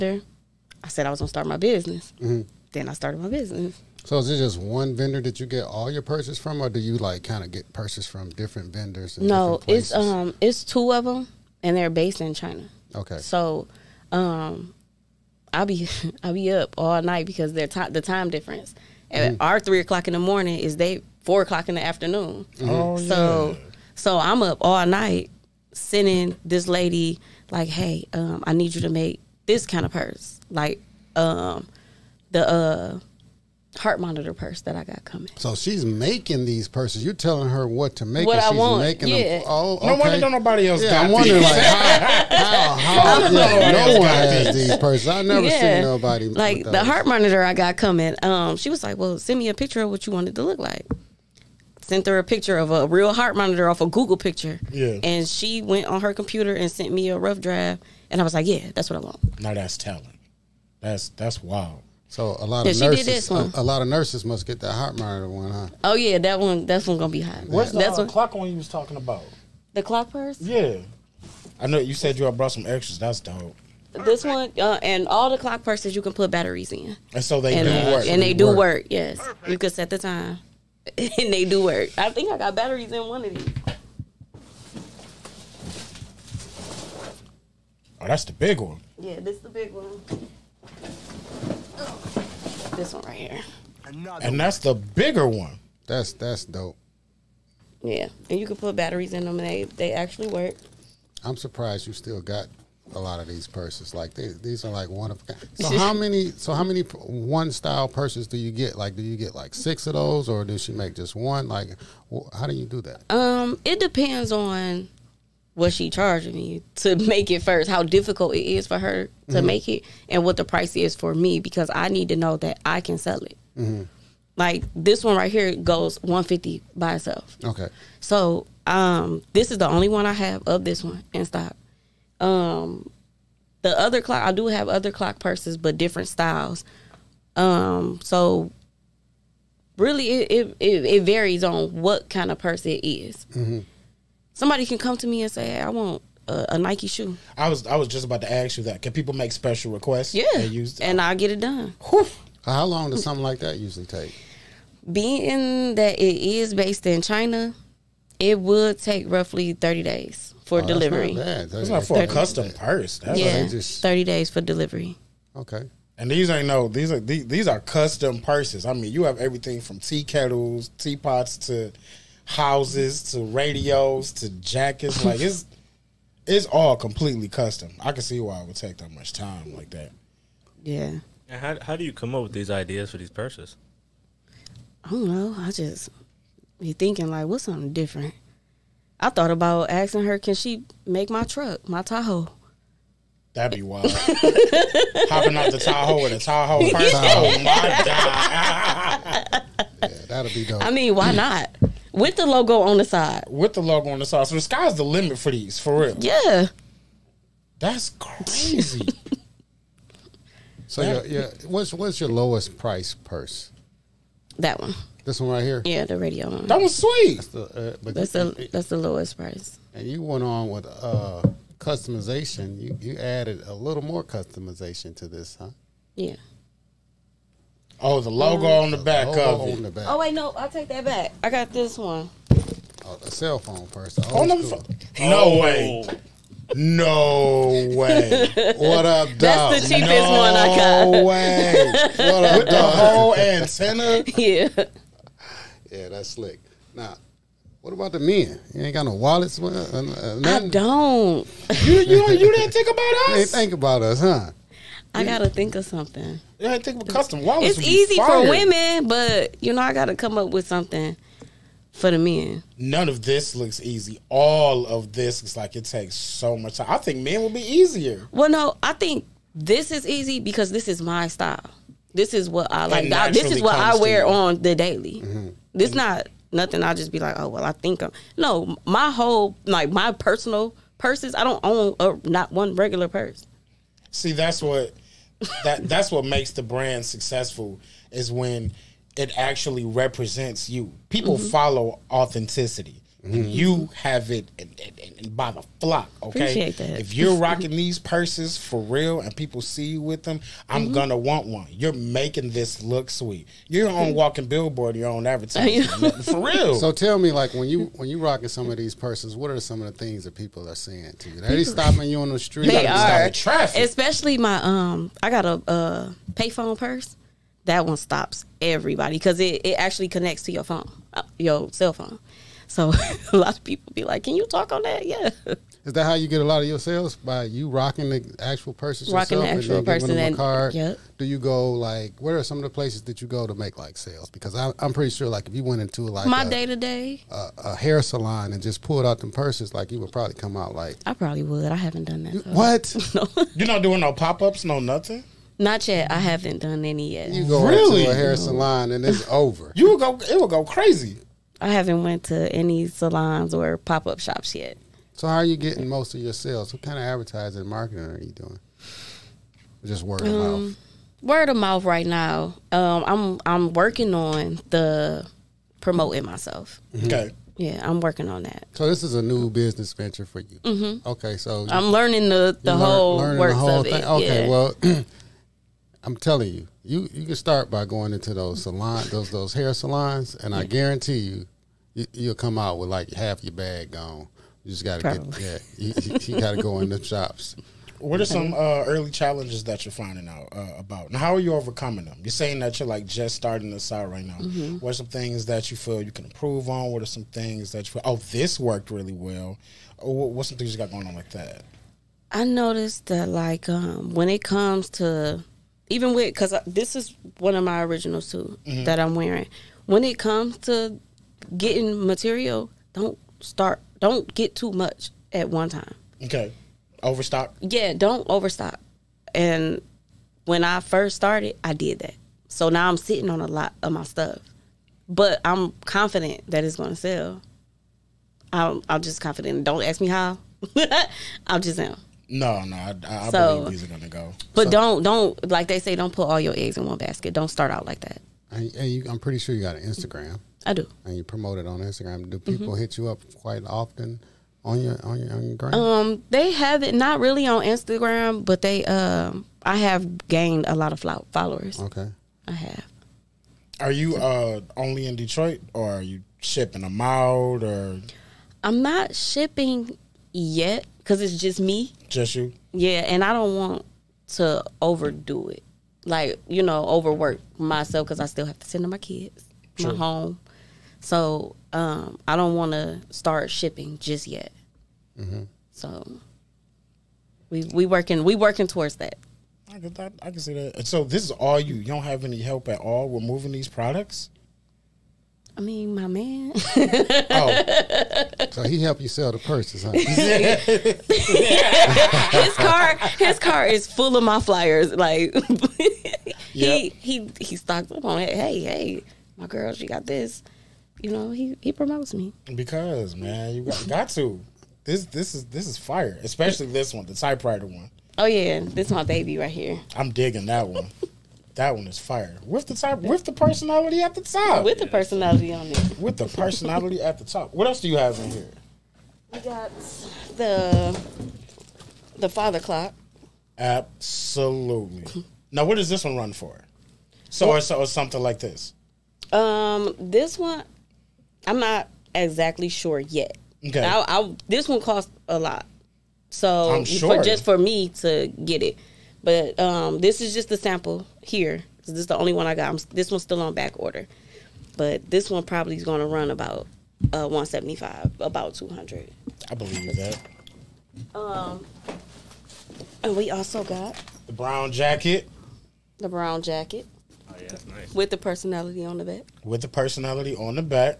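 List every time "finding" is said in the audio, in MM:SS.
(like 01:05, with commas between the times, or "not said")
06:29.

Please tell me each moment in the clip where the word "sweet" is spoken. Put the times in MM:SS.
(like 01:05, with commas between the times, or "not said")
03:36, 05:02.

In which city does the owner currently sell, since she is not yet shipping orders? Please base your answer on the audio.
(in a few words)
Detroit.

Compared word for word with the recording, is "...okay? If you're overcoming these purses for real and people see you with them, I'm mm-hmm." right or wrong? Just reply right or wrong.
wrong.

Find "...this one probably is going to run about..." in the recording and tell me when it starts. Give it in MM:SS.
09:04.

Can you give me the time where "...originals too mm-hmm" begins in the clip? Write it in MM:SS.
06:47.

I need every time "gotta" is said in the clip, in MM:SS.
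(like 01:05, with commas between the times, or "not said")
04:15, 04:19.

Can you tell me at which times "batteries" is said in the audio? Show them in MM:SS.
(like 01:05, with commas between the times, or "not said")
01:16, 01:22, 01:38.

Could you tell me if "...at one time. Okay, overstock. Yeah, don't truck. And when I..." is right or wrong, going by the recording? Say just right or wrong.
wrong.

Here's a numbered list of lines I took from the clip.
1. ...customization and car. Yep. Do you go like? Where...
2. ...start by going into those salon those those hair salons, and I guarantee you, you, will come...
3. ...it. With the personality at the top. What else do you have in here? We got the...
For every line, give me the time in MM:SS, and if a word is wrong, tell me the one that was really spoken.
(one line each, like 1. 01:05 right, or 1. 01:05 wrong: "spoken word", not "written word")
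1. 05:29 wrong: "person", not "customization"
2. 06:17 right
3. 08:35 right.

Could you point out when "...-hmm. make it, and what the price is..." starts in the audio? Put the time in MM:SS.
01:59.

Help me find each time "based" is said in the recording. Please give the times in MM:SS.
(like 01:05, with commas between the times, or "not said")
00:11, 02:36.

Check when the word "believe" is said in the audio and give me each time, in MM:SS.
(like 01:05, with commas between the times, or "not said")
07:13, 09:09.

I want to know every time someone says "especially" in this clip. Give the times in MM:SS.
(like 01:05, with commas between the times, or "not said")
05:13, 08:26.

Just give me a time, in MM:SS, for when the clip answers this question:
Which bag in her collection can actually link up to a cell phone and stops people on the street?
05:16.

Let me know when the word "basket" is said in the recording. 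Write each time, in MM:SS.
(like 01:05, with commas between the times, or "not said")
07:16.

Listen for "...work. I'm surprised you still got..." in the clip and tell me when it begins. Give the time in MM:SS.
01:40.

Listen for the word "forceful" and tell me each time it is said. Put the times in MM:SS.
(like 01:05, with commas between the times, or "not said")
not said.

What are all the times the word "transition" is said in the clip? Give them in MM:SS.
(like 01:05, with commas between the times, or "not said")
not said.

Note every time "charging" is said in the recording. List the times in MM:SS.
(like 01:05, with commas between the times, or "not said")
01:55.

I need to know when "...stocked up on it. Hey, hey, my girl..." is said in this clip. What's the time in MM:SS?
08:17.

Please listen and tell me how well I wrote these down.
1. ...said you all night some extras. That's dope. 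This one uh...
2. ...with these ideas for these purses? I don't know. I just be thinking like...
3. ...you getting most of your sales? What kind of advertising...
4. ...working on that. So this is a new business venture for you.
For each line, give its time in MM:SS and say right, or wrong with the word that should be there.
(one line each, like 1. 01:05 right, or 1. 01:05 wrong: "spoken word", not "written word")
1. 01:11 wrong: "brought", not "night"
2. 03:02 right
3. 05:55 right
4. 06:07 right.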